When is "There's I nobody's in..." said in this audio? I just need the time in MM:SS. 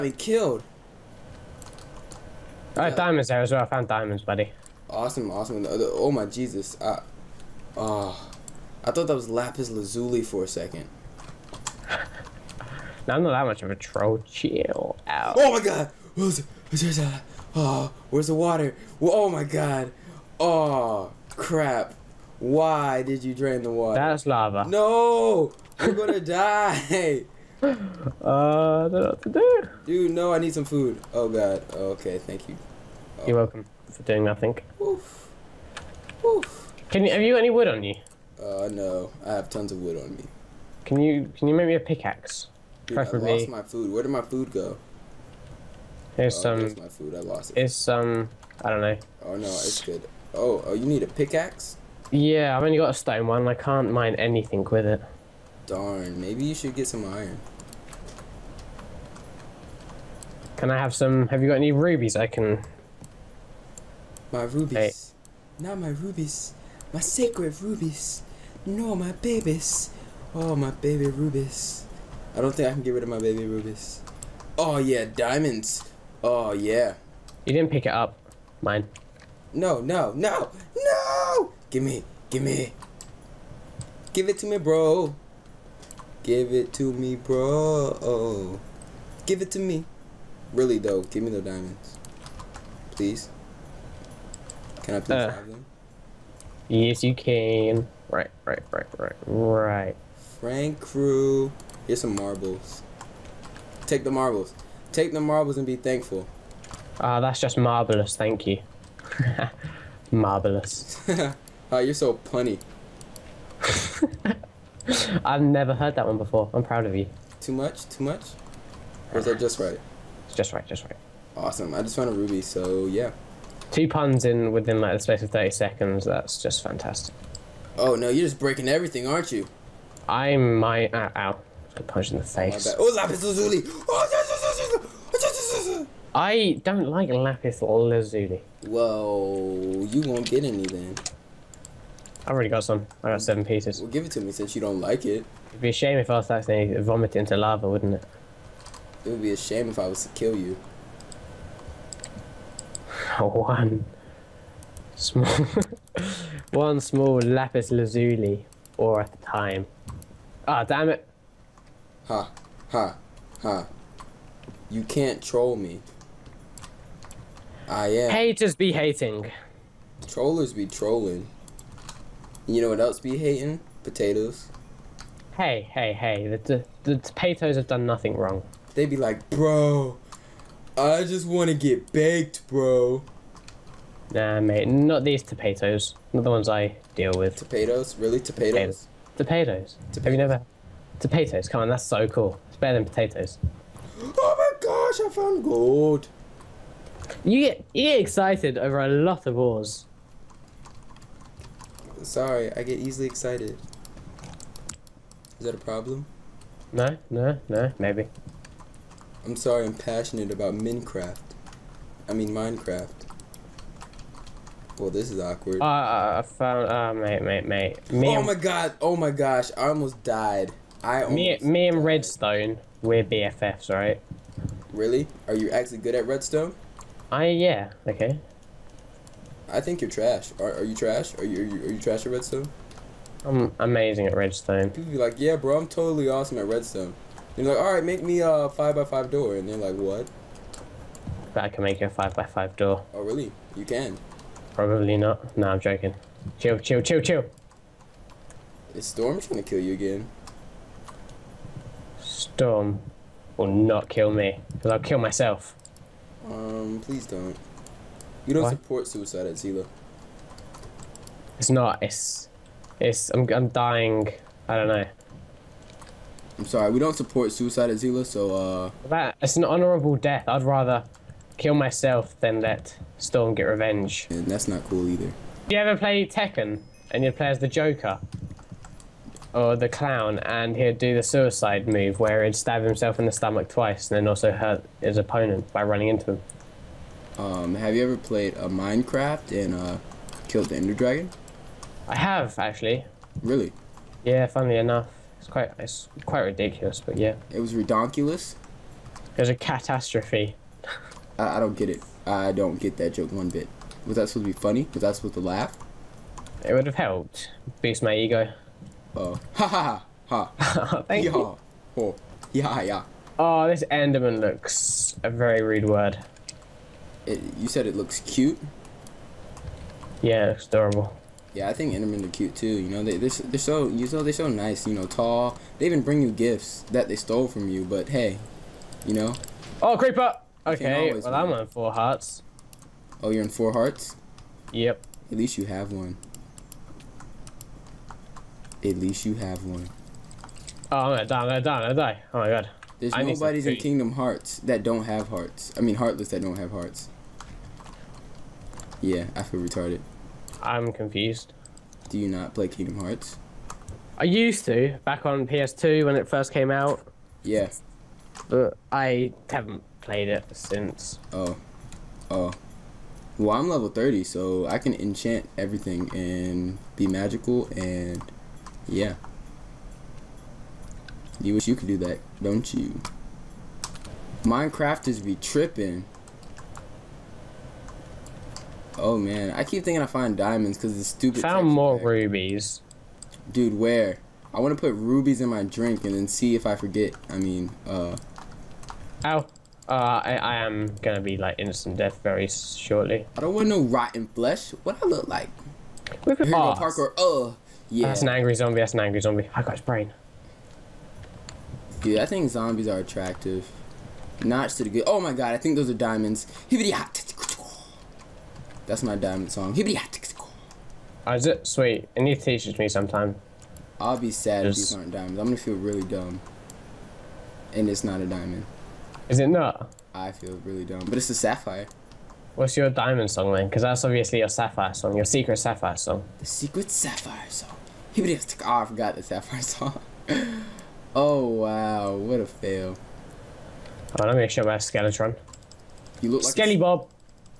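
05:42.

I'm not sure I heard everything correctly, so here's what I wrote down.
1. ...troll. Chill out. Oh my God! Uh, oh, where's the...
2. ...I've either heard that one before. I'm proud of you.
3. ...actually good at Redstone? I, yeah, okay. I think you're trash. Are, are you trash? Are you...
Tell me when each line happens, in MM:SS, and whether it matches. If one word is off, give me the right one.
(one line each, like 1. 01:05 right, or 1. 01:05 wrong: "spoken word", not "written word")
1. 00:13 right
2. 01:55 wrong: "never", not "either"
3. 03:45 right.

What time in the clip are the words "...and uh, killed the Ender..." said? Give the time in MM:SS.
04:49.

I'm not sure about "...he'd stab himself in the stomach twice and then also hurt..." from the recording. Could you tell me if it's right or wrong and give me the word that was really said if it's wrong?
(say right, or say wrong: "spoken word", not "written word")
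right.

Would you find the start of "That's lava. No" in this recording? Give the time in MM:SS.
00:24.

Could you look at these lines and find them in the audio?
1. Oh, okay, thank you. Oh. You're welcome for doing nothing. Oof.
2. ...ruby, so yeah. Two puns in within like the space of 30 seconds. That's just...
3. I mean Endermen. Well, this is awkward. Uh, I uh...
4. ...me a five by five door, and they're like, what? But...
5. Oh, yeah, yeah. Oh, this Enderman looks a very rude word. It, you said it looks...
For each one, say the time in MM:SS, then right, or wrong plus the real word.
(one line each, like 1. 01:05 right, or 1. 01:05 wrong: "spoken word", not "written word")
1. 00:31 right
2. 02:02 right
3. 03:32 wrong: "Minecraft", not "Endermen"
4. 03:58 right
5. 05:11 right.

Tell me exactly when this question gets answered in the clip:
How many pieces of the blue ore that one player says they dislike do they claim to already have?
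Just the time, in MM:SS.
02:23.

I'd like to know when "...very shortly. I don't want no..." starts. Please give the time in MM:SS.
06:32.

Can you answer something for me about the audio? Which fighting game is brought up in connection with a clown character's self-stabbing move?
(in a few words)
Tekken.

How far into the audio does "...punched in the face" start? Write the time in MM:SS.
02:11.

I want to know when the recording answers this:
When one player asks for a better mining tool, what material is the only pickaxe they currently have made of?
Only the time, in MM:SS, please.
00:52.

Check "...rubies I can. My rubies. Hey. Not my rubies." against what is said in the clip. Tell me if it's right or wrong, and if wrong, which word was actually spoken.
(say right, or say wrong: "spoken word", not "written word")
right.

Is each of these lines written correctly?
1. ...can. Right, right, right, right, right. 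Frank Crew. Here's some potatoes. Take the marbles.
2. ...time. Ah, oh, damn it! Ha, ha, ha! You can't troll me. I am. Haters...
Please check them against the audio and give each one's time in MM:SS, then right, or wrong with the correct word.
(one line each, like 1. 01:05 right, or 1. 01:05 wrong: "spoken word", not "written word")
1. 01:37 wrong: "marbles", not "potatoes"
2. 02:39 right.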